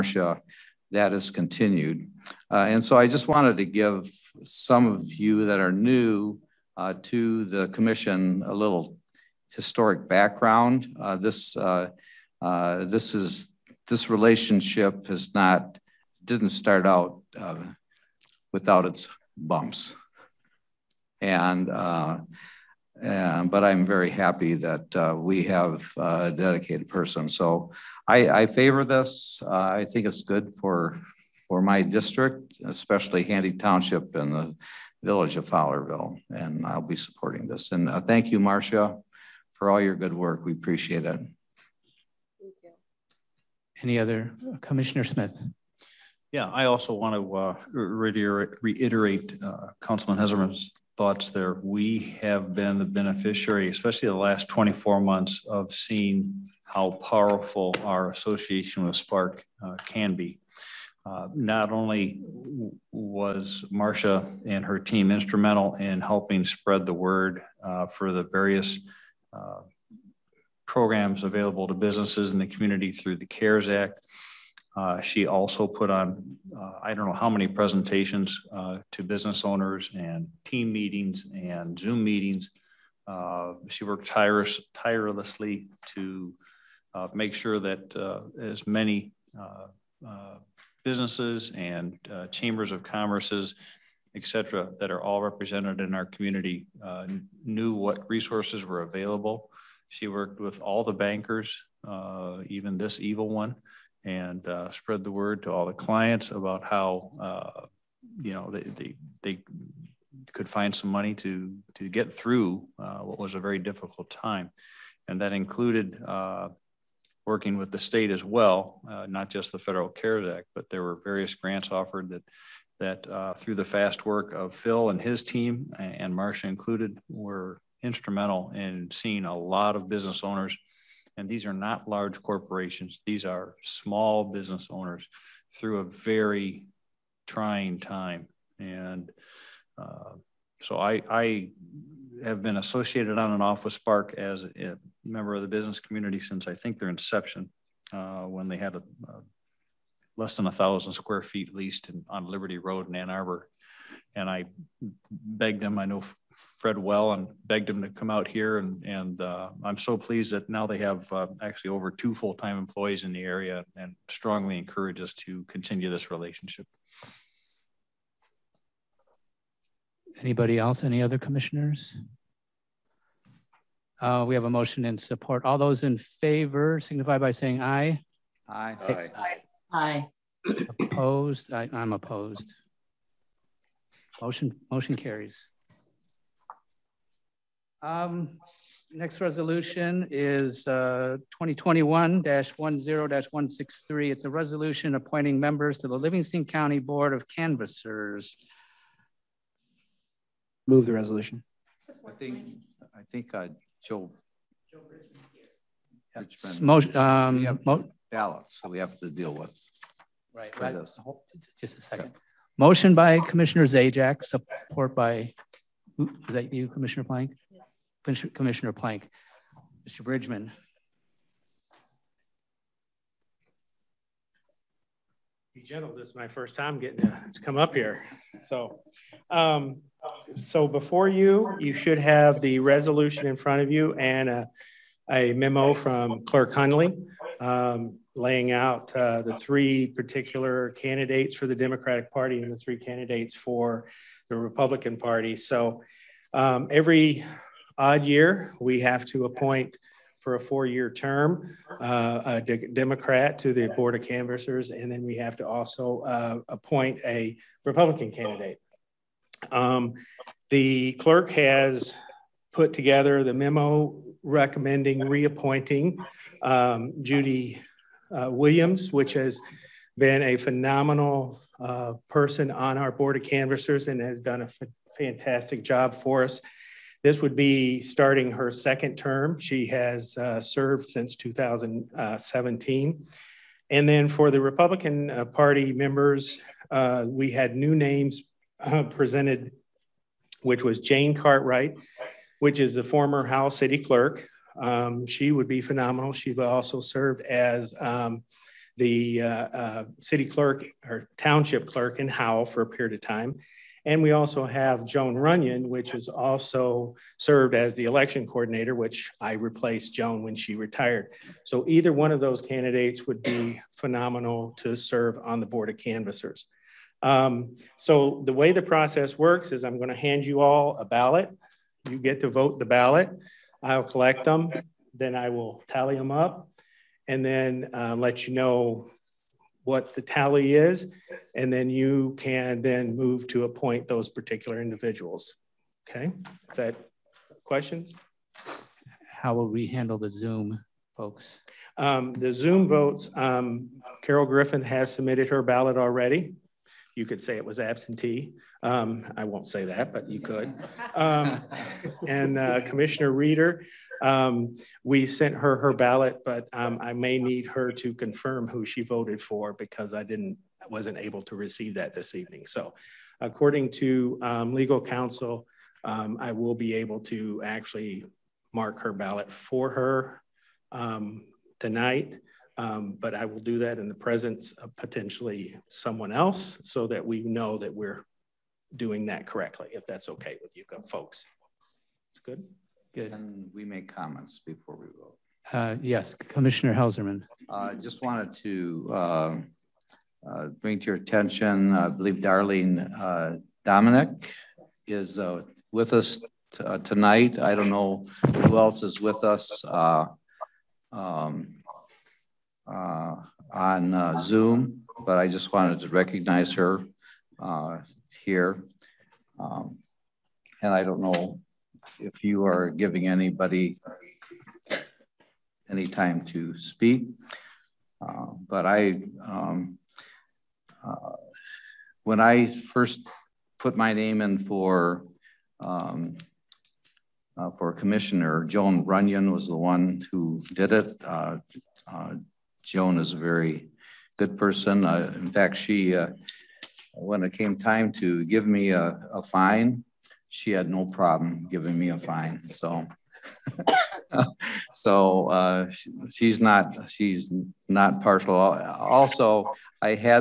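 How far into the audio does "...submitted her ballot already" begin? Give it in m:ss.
5:44.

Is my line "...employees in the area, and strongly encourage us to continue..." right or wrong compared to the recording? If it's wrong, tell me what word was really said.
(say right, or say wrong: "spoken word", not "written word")
right.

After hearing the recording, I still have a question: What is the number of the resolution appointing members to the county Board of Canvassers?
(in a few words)
2021-10-163.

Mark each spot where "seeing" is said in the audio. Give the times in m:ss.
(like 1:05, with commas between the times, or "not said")
0:55, 2:08.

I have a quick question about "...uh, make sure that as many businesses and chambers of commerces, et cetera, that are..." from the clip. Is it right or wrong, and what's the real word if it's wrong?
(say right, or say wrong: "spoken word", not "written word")
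right.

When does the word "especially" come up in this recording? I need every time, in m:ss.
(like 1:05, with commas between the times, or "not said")
0:32, 0:53.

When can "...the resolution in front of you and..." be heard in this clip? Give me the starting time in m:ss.
3:52.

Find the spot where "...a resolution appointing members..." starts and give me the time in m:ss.
3:14.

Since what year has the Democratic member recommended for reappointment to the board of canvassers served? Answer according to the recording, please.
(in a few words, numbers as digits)
2017.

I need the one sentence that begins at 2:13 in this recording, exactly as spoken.
These are small business owners through a very trying time.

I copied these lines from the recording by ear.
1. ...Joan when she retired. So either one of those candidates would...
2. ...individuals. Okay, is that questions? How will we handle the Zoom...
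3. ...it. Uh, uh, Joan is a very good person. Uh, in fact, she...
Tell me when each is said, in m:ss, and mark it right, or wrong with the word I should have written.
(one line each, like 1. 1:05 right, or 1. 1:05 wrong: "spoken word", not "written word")
1. 5:09 right
2. 5:34 right
3. 7:10 right.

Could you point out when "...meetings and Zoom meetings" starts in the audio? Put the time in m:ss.
1:20.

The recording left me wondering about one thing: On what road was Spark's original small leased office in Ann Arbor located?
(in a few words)
Liberty Road.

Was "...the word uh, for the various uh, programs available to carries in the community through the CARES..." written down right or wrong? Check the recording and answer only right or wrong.
wrong.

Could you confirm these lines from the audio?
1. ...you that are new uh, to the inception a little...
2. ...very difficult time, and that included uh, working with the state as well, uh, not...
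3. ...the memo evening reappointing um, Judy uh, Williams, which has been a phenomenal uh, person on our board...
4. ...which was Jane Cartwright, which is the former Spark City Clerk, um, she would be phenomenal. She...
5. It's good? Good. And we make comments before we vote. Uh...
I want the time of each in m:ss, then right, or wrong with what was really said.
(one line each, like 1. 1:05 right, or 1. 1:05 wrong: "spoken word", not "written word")
1. 0:05 wrong: "commission", not "inception"
2. 1:53 right
3. 4:23 wrong: "recommending", not "evening"
4. 4:50 wrong: "Howell", not "Spark"
5. 6:21 right.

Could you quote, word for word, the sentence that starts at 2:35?
I know Fred well, and begged him to come out here.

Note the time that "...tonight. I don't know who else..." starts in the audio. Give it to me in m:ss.
6:36.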